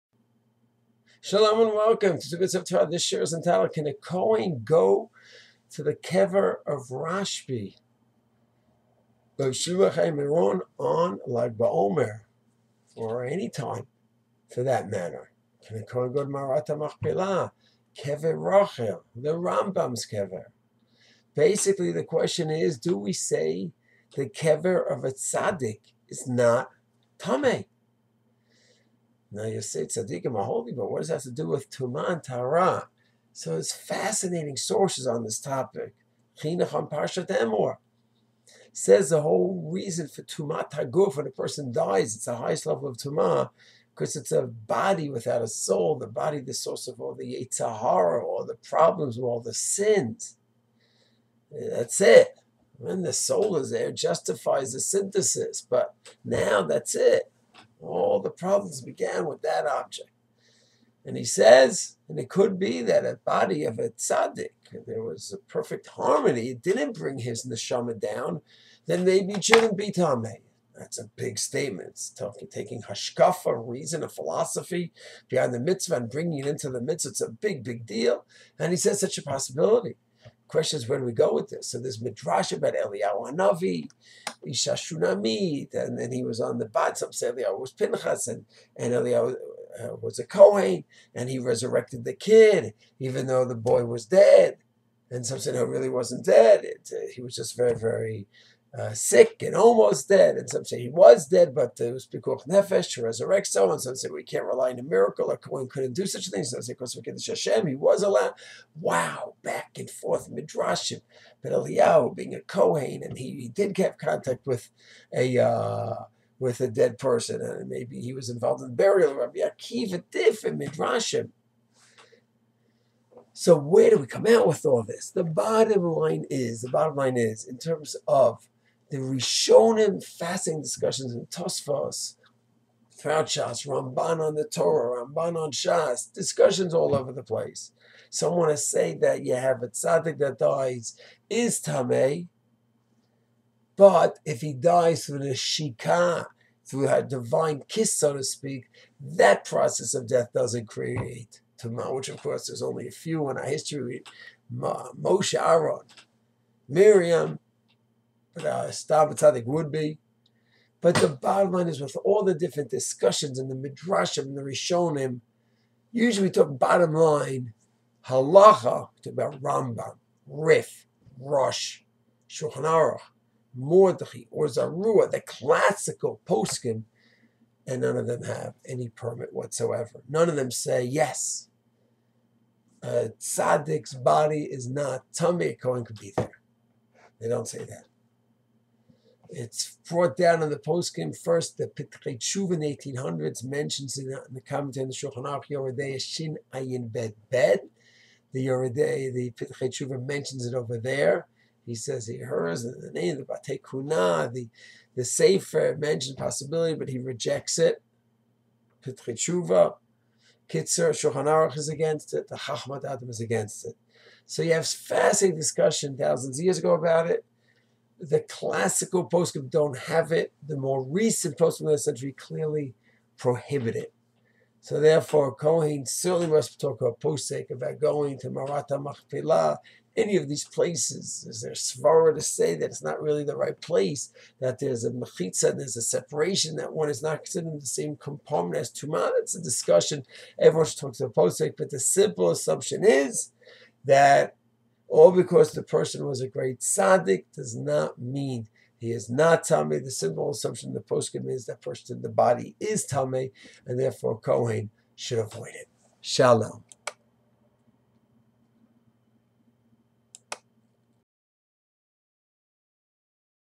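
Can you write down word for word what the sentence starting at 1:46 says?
Some say because we Hashem, he was allowed.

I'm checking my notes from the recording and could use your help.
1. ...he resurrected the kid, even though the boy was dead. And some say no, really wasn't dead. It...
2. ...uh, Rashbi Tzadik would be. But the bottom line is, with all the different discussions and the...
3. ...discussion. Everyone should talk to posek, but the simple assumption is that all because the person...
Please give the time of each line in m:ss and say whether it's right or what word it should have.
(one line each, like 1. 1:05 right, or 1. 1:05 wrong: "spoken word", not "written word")
1. 1:31 right
2. 2:38 wrong: "Stam", not "Rashbi"
3. 3:59 right.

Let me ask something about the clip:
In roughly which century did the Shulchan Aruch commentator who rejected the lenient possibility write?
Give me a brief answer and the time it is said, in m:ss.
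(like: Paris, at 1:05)
1800s, at 3:12.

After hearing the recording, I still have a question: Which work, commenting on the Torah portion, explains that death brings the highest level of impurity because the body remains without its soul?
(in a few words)
Chinuch.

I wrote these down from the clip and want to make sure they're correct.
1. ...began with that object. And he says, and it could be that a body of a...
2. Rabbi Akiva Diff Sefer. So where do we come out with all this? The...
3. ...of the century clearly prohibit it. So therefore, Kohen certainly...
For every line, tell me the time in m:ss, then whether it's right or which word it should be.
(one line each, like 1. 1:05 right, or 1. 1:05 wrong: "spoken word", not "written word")
1. 0:58 right
2. 1:59 wrong: "Midrashim", not "Sefer"
3. 3:41 right.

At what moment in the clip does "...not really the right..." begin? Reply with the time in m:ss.
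3:52.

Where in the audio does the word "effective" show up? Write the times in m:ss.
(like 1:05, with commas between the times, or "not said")
not said.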